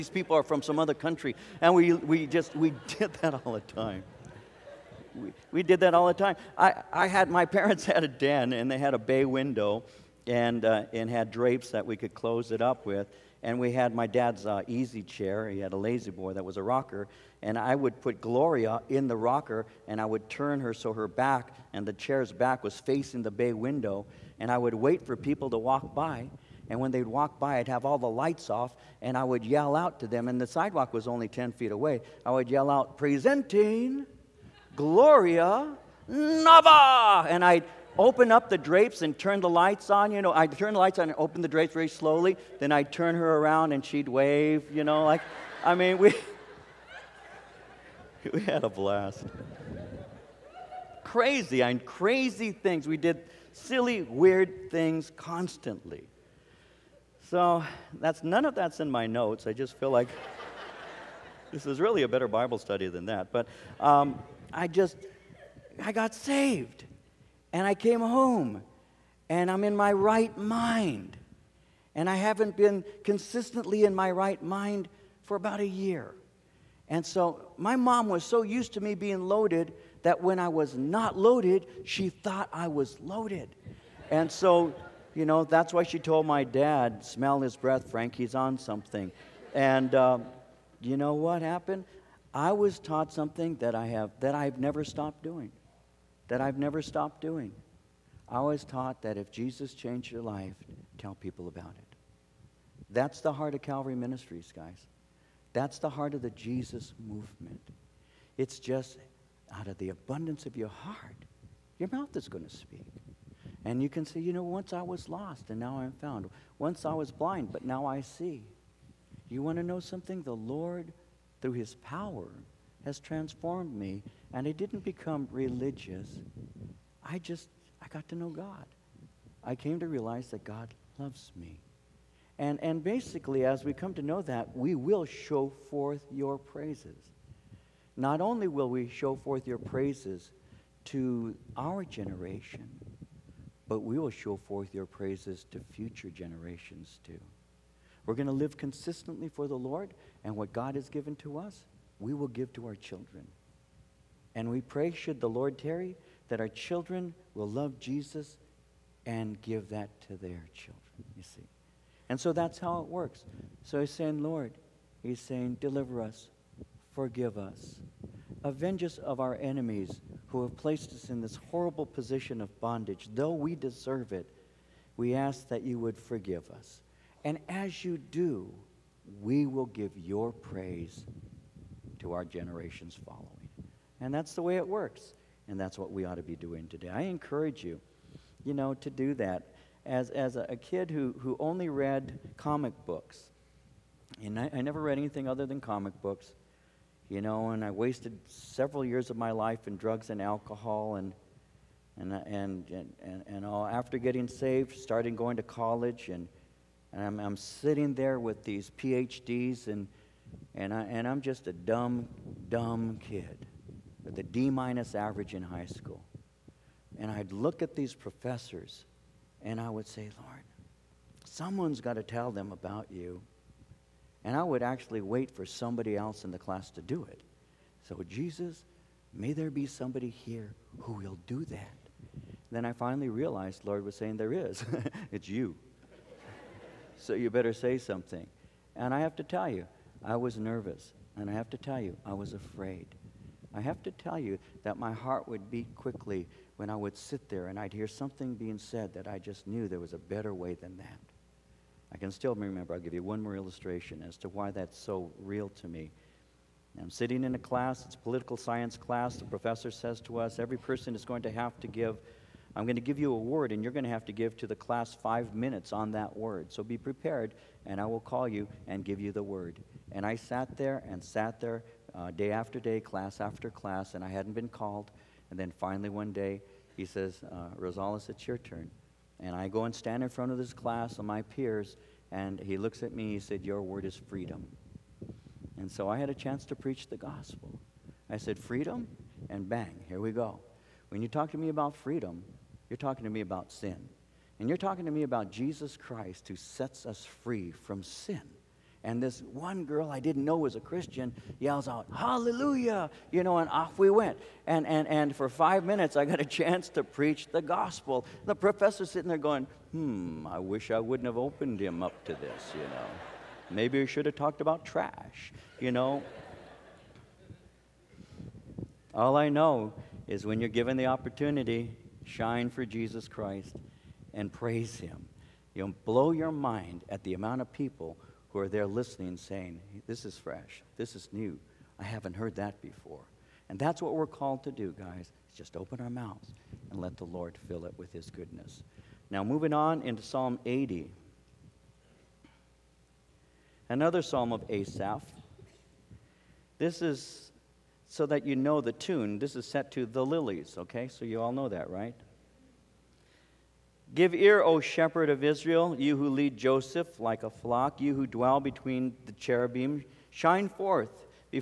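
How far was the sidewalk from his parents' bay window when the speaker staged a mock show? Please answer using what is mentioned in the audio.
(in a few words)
10 feet.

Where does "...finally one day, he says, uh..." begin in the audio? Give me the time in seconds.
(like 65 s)
275 s.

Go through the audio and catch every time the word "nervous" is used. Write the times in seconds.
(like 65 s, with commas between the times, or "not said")
240 s.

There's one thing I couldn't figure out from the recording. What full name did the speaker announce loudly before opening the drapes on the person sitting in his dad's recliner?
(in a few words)
Gloria Nava.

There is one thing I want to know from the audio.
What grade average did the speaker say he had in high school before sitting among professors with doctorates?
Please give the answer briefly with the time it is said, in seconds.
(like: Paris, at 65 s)
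D minus, at 214 s.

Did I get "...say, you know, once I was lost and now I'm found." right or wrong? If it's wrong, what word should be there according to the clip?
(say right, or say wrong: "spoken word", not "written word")
right.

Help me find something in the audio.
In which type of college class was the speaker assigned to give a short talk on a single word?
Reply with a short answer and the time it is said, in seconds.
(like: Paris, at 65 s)
Political science, at 257 s.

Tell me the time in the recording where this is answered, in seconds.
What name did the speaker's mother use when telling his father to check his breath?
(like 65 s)
87 s.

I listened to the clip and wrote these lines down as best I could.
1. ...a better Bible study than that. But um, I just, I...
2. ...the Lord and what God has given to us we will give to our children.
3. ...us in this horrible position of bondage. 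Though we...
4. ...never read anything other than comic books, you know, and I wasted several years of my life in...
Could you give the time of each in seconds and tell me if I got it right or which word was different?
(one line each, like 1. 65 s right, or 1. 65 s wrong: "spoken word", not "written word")
1. 62 s right
2. 149 s right
3. 170 s right
4. 194 s right.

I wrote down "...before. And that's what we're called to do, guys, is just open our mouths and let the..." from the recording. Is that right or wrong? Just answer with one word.
right.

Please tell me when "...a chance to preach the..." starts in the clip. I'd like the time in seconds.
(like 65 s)
286 s.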